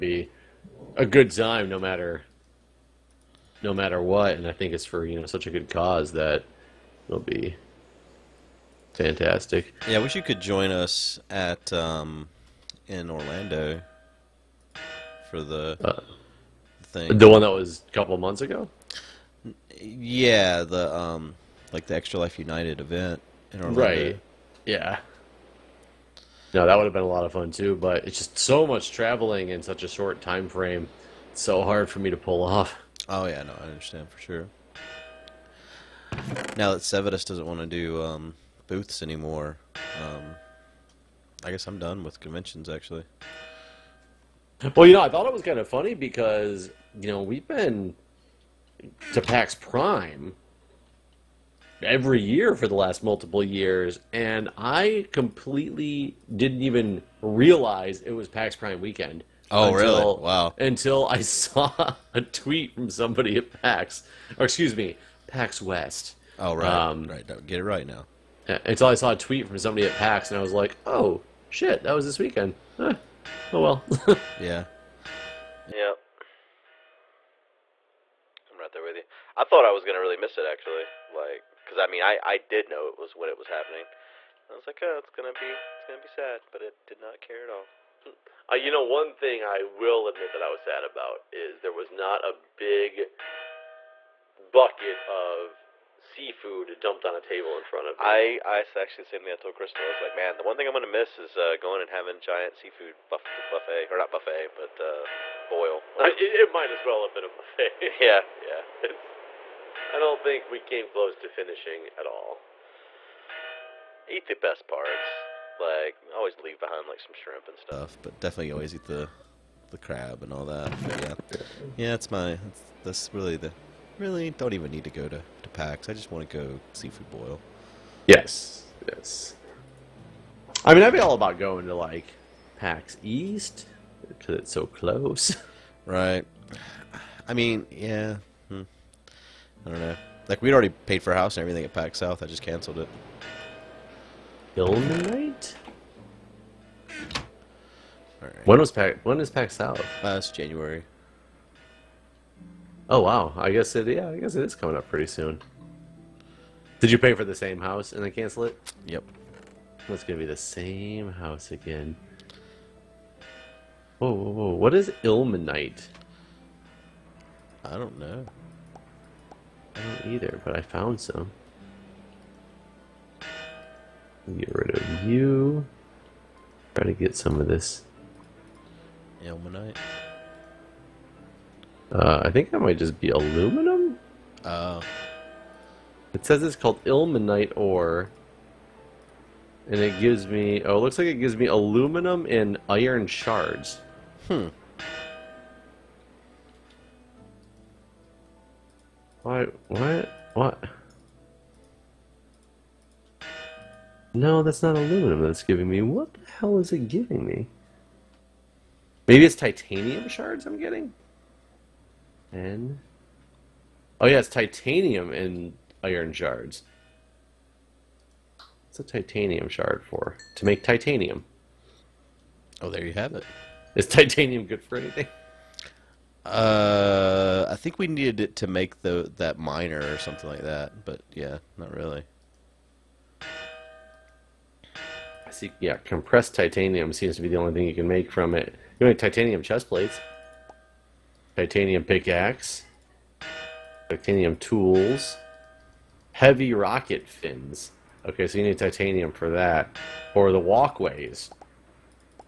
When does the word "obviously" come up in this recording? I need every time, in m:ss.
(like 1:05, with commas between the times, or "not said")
not said.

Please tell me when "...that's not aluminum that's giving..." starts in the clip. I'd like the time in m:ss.
3:24.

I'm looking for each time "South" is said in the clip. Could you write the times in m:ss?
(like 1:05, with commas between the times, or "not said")
2:21, 2:29.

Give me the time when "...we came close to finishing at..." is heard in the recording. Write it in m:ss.
1:50.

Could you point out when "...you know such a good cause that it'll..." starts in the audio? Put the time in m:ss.
0:05.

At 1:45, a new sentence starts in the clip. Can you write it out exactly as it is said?
It, it, might as well have been a buffet.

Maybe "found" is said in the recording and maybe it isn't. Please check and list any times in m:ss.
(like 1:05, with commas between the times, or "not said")
2:50.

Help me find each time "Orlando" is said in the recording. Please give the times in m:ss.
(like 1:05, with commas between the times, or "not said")
0:13, 0:23.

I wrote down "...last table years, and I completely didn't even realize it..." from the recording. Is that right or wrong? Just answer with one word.
wrong.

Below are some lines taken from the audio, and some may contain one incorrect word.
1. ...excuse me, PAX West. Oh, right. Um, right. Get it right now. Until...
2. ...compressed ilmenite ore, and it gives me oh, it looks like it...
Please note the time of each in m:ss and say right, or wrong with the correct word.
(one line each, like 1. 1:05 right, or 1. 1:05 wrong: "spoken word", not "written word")
1. 1:04 right
2. 3:06 wrong: "called", not "compressed".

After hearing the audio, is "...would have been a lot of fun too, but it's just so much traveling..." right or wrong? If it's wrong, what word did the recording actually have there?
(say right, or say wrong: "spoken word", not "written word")
right.